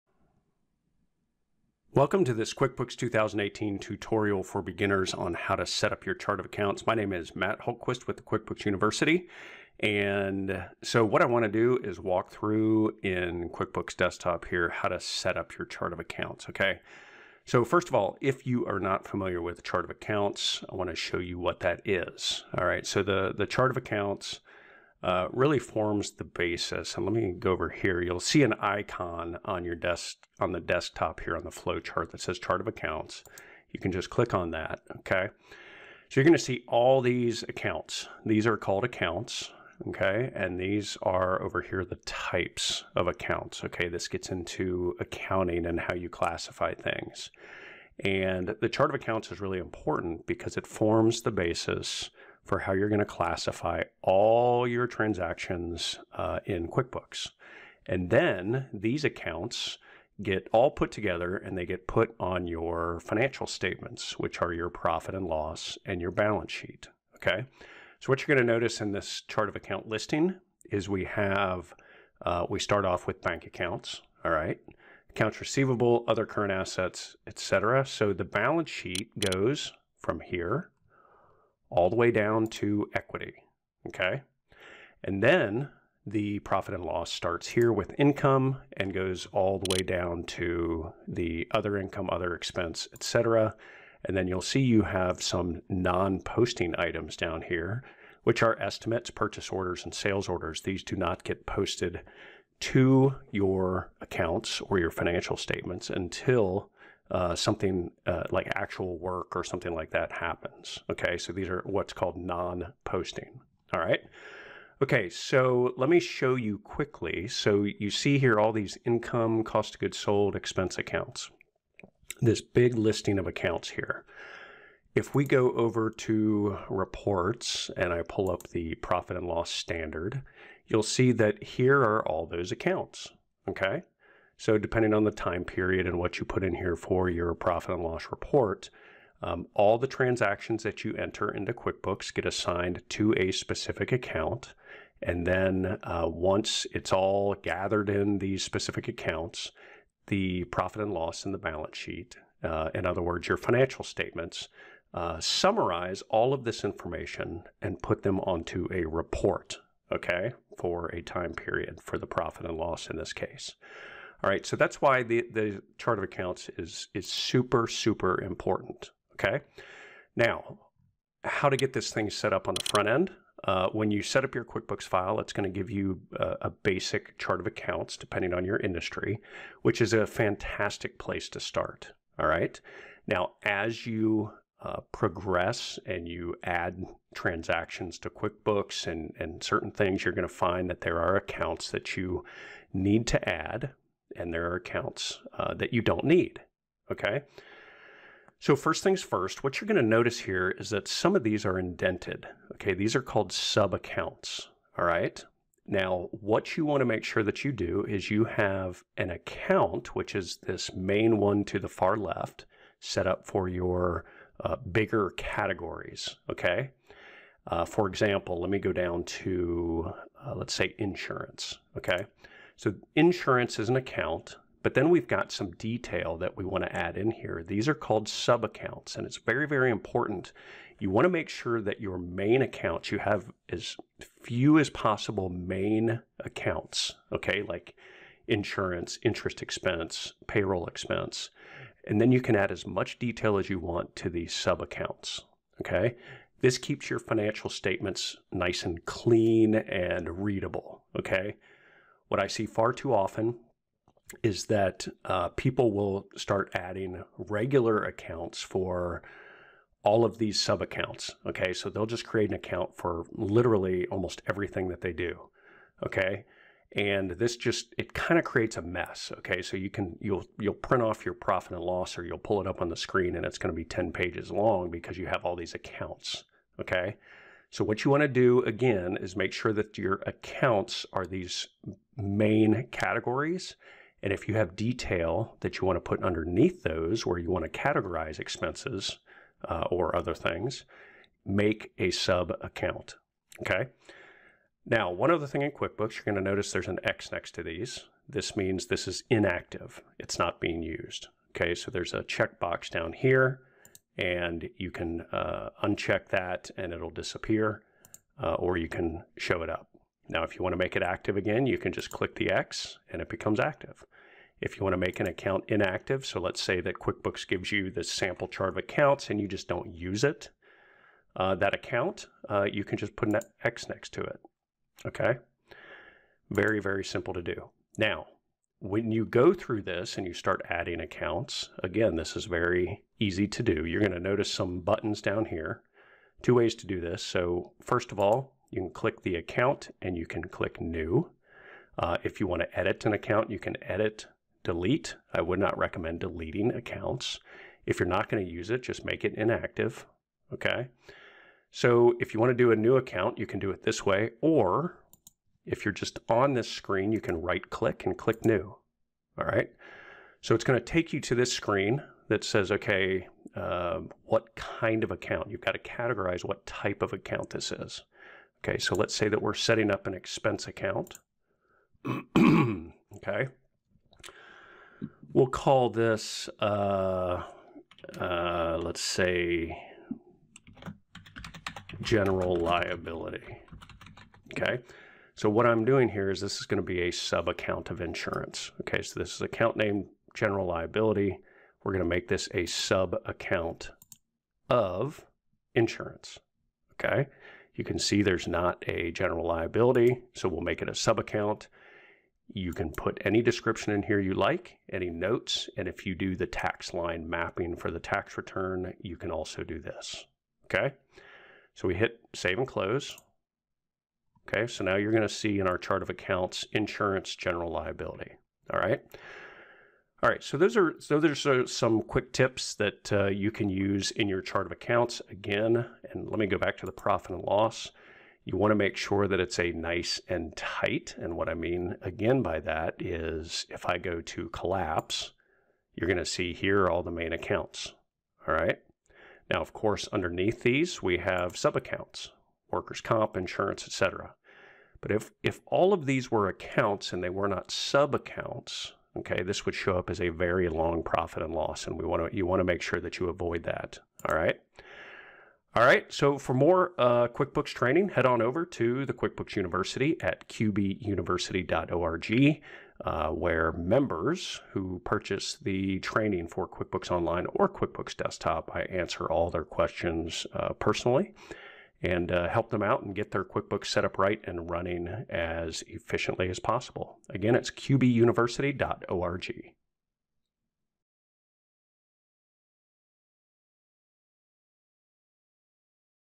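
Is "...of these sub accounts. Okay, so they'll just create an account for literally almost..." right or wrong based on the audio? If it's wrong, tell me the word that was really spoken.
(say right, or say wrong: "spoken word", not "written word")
right.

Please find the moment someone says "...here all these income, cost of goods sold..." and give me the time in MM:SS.
01:58.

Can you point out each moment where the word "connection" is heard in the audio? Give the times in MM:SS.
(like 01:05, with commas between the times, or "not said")
not said.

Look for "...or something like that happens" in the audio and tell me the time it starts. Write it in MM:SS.
01:49.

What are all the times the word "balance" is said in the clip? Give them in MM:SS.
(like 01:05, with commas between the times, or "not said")
01:06, 01:18, 02:31.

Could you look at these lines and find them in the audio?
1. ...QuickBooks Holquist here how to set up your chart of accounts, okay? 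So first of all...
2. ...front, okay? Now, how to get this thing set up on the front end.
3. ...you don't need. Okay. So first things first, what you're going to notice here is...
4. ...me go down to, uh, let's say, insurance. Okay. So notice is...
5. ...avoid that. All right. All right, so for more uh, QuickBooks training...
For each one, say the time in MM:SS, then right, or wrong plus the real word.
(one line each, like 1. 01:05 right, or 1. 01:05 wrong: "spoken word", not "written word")
1. 00:13 wrong: "Desktop", not "Holquist"
2. 02:48 wrong: "important", not "front"
3. 03:15 right
4. 03:38 wrong: "insurance", not "notice"
5. 07:33 right.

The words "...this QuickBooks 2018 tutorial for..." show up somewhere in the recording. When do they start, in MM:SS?
00:02.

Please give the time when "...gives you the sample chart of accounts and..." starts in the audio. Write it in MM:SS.
05:17.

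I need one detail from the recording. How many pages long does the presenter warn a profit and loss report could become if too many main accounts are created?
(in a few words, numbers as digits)
10.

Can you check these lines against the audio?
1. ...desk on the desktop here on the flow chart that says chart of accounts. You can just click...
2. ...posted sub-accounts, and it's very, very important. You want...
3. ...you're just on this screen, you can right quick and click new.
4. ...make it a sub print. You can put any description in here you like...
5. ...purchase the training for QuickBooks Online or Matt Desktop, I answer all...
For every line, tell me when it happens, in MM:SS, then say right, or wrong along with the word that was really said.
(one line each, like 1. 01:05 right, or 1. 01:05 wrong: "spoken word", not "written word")
1. 00:29 right
2. 03:47 wrong: "called", not "posted"
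3. 05:55 wrong: "click", not "quick"
4. 06:40 wrong: "account", not "print"
5. 07:44 wrong: "QuickBooks", not "Matt".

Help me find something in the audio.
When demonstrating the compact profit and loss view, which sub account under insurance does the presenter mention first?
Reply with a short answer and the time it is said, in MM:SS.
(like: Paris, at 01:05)
Workers' comp, at 07:22.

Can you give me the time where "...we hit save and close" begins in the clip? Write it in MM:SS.
06:51.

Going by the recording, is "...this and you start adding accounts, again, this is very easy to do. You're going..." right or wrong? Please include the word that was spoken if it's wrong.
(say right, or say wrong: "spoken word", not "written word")
right.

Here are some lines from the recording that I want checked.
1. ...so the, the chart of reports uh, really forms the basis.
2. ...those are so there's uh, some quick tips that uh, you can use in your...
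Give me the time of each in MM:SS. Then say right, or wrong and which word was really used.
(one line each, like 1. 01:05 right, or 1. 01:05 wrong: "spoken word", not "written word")
1. 00:22 wrong: "accounts", not "reports"
2. 07:00 right.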